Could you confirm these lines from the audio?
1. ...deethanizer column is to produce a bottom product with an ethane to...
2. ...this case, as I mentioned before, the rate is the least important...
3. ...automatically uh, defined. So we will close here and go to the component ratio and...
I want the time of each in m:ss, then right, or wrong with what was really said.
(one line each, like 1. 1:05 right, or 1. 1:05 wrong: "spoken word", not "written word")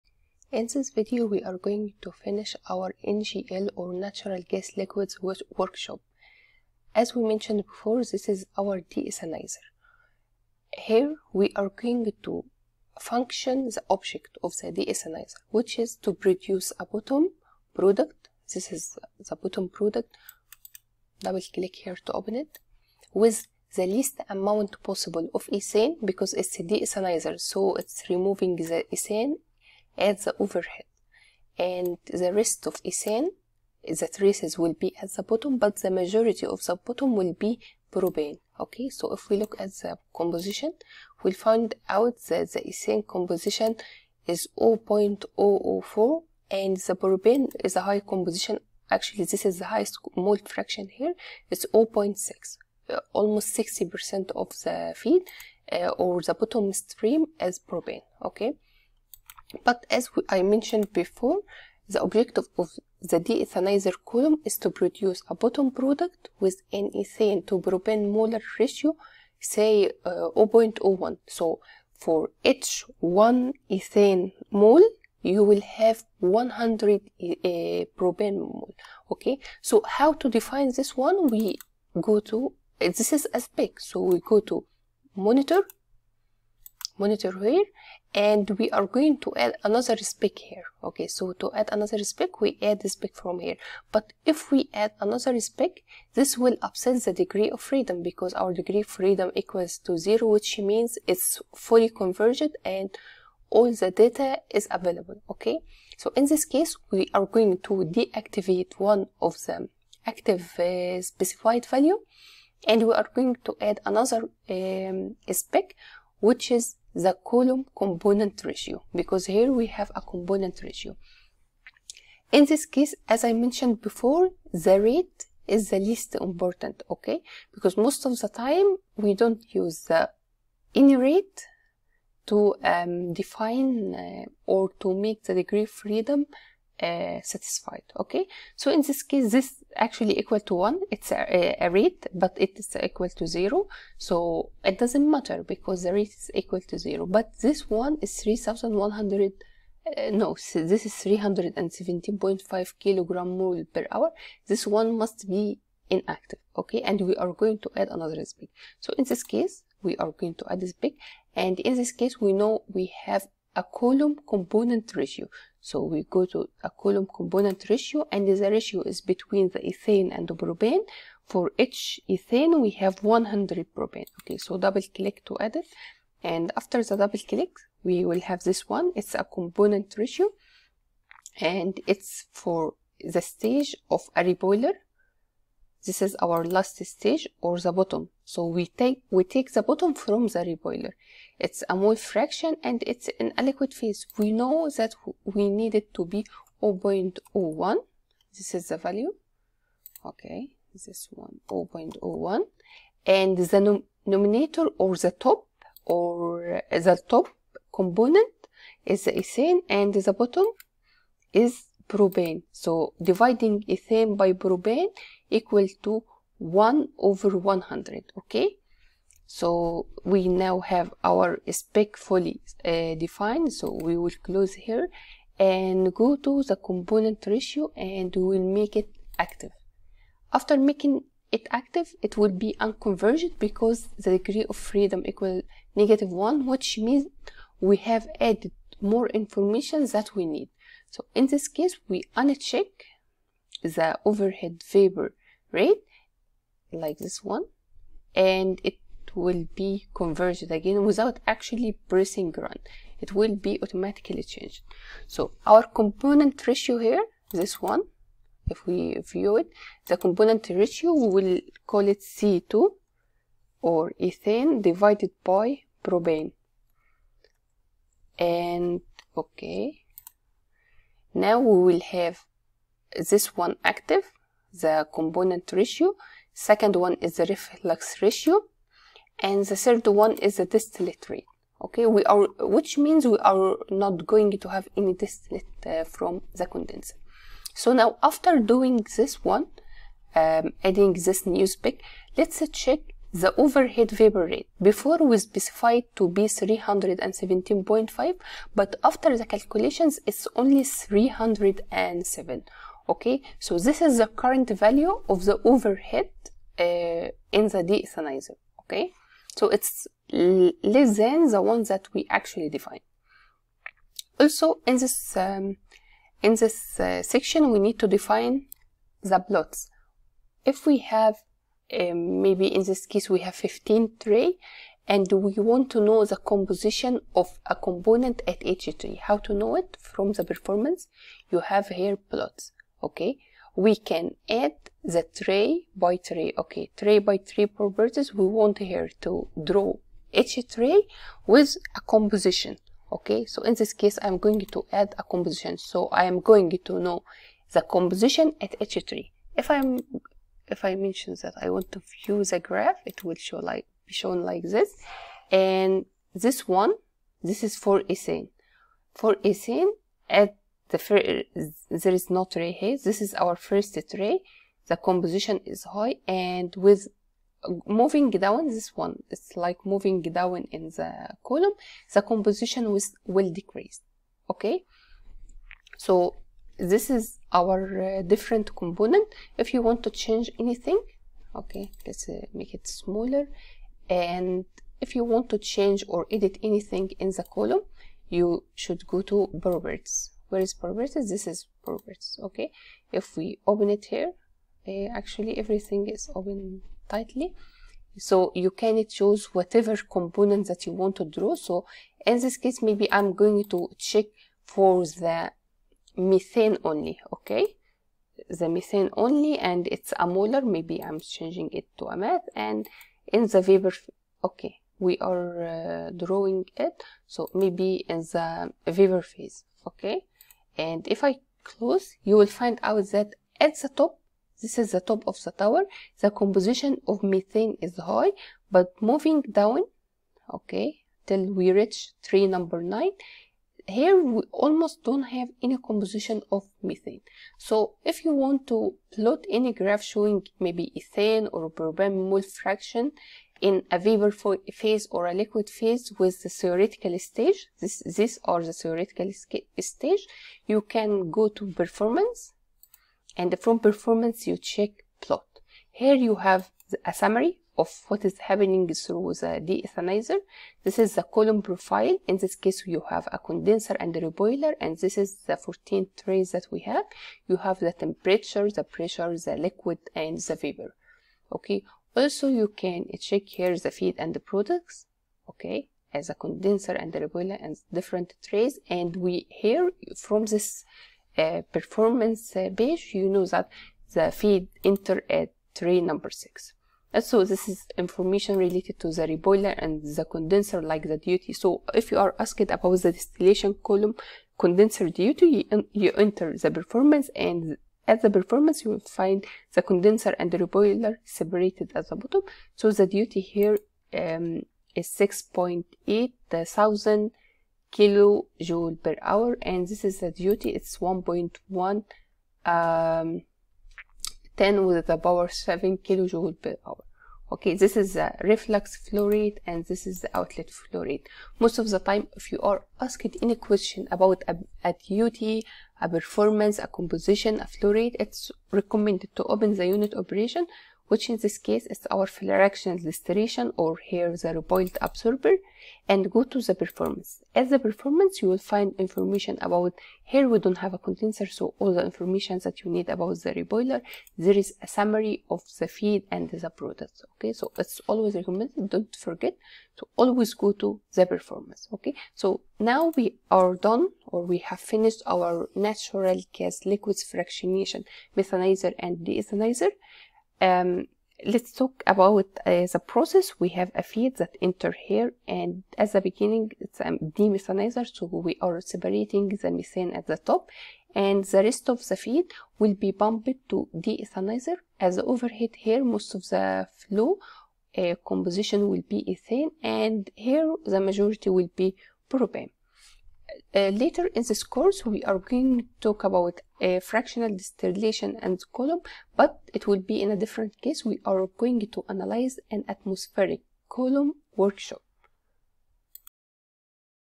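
1. 1:03 right
2. 2:02 right
3. 3:41 wrong: "fully", not "automatically".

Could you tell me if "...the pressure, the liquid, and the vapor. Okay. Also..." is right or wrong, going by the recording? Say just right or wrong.
right.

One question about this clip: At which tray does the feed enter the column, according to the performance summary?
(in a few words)
tray number six.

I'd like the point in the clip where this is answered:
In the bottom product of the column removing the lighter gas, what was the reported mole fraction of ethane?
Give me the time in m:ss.
0:44.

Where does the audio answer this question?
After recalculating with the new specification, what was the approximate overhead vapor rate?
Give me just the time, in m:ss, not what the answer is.
5:00.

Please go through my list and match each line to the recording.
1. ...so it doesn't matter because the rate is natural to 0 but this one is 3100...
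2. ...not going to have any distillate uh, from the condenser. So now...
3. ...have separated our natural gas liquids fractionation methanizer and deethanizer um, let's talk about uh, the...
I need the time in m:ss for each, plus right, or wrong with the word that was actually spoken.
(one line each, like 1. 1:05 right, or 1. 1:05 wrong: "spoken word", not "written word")
1. 2:23 wrong: "equal", not "natural"
2. 4:43 right
3. 9:14 wrong: "finished", not "separated".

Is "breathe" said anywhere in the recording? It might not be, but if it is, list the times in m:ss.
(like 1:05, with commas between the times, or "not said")
not said.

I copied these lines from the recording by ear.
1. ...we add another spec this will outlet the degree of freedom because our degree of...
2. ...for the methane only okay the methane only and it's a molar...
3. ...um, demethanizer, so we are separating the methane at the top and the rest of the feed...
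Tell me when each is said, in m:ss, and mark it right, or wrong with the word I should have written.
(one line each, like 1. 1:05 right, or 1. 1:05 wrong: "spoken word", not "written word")
1. 1:34 wrong: "upset", not "outlet"
2. 6:44 right
3. 9:26 right.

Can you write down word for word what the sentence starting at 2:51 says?
For each ethane we have 100 propane.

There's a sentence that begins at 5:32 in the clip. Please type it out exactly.
Okay, we can add the tray by tray.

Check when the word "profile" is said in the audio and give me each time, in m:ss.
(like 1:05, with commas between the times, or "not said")
7:41.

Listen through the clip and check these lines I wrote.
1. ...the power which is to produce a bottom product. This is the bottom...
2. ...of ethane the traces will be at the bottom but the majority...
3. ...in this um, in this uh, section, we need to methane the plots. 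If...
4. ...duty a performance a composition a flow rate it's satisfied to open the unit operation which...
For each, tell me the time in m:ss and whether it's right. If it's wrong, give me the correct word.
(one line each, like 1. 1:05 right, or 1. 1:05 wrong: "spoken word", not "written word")
1. 0:14 wrong: "deethanizer", not "power"
2. 0:32 right
3. 5:14 wrong: "define", not "methane"
4. 8:44 wrong: "recommended", not "satisfied".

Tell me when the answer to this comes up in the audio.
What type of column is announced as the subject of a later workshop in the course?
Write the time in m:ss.
9:52.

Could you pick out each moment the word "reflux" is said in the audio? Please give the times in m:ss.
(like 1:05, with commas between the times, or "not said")
4:37, 8:38.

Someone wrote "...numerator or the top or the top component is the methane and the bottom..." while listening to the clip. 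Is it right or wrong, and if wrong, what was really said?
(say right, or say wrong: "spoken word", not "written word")
wrong: "ethane", not "methane".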